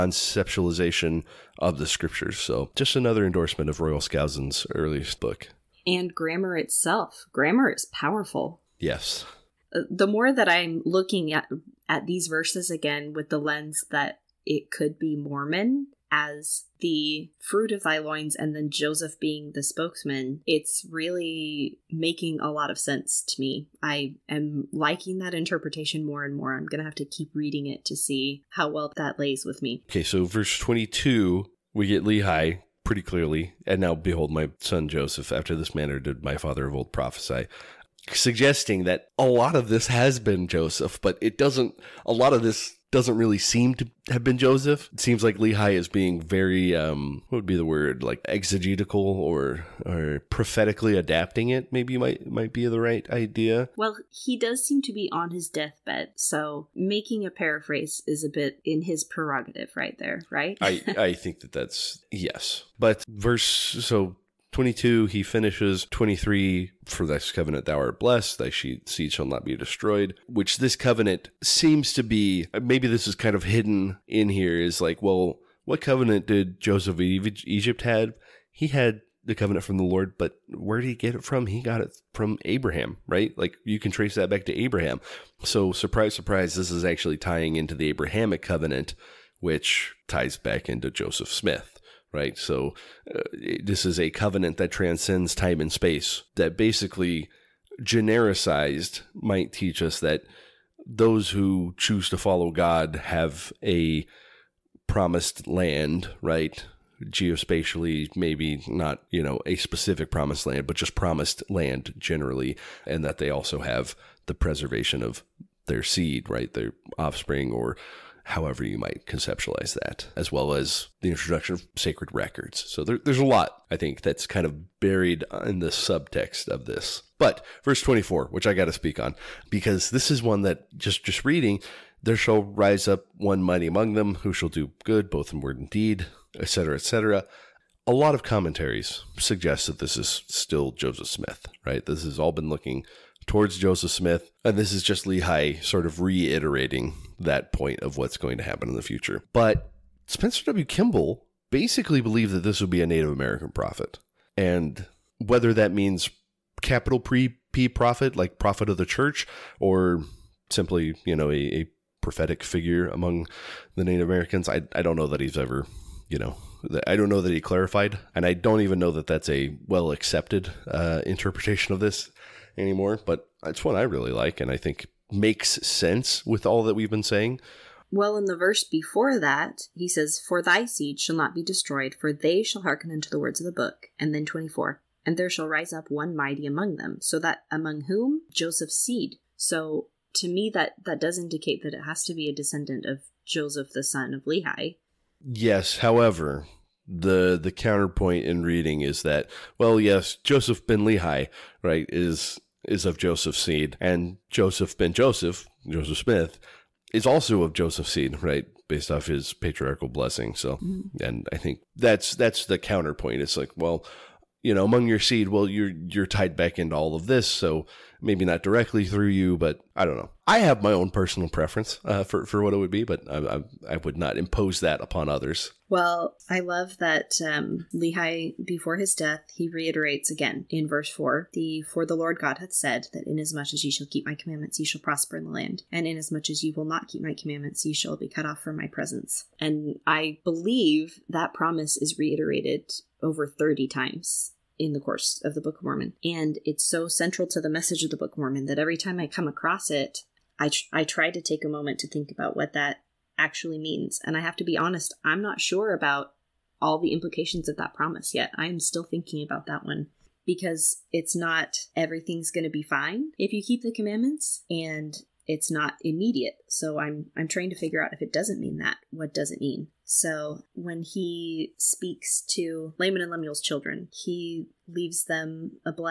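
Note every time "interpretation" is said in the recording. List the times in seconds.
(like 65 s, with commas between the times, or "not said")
25 s, 171 s.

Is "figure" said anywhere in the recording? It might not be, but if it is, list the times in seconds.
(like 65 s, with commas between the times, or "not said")
162 s, 267 s.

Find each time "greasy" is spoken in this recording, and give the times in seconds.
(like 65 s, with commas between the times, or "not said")
not said.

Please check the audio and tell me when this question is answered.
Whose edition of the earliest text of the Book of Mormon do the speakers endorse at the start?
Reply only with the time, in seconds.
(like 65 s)
3 s.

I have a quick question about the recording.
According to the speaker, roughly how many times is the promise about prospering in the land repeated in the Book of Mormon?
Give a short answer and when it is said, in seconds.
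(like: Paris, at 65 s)
Over 30, at 243 s.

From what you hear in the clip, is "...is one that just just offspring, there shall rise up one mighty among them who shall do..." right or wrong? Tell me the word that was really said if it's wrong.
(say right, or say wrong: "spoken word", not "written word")
wrong: "reading", not "offspring".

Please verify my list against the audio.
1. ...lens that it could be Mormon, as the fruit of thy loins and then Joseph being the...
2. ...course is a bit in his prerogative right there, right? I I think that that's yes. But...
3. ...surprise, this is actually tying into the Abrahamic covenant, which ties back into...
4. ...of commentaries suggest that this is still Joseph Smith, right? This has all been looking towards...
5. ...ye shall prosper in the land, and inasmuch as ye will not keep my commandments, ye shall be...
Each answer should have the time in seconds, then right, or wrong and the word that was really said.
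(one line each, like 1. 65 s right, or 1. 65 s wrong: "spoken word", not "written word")
1. 13 s right
2. 57 s wrong: "paraphrase", not "course"
3. 86 s right
4. 138 s right
5. 234 s right.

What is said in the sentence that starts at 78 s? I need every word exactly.
He had the covenant from the Lord, but where did he get it from?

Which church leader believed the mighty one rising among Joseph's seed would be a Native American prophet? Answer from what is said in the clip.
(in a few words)
Spencer W. Kimball.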